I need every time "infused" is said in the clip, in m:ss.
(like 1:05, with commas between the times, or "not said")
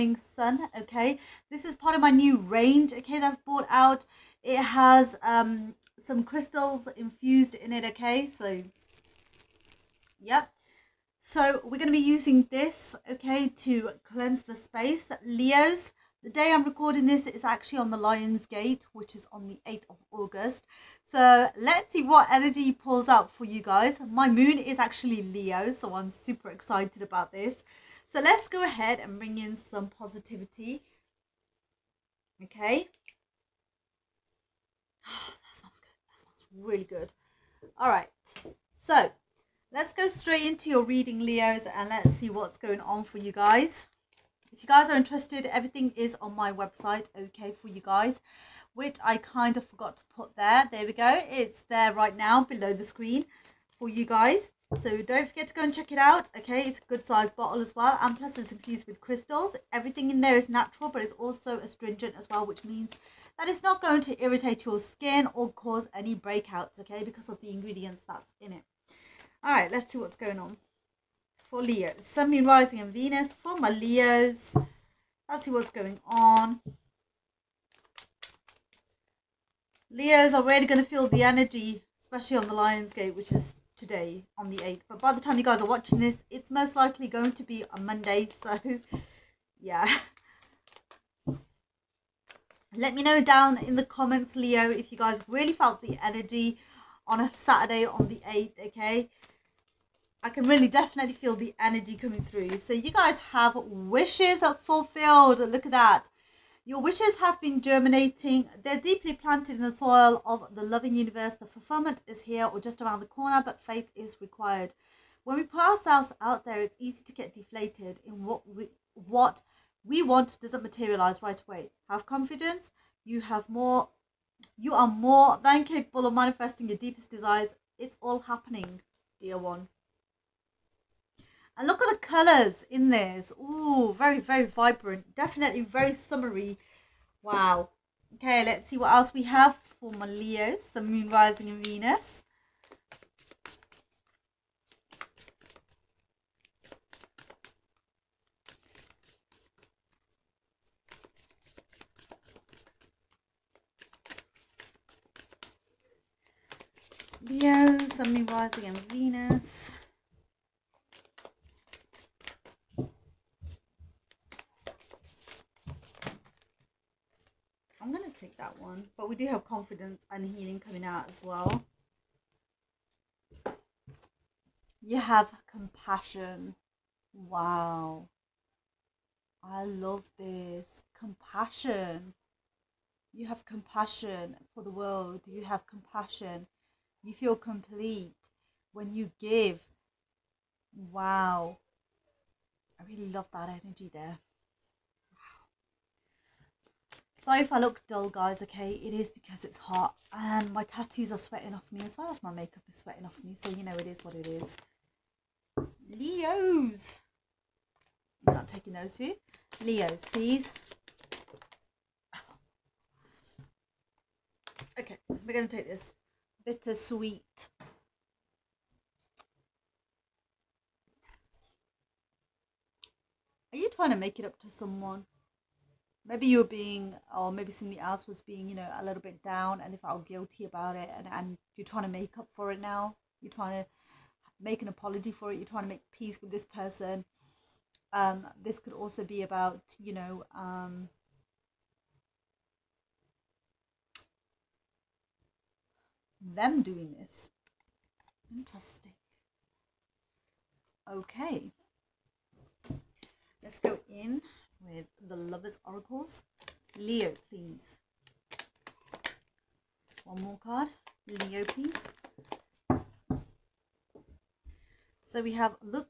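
0:06, 0:58.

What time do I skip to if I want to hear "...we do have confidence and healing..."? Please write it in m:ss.
2:49.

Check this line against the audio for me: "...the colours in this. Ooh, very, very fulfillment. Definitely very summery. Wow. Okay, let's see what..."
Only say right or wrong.
wrong.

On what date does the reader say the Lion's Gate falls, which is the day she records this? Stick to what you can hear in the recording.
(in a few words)
8th of August.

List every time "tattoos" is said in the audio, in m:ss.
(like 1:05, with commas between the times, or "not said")
3:20.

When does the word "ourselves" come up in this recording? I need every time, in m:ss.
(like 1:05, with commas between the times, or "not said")
1:55.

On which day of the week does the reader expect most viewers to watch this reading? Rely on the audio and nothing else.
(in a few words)
Monday.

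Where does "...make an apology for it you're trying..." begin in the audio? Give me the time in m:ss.
3:54.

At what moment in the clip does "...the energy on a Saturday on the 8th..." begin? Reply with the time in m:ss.
1:35.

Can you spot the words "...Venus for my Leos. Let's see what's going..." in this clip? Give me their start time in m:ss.
1:12.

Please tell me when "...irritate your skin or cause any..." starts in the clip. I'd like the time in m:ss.
1:04.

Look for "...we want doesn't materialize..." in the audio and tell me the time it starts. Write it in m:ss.
1:59.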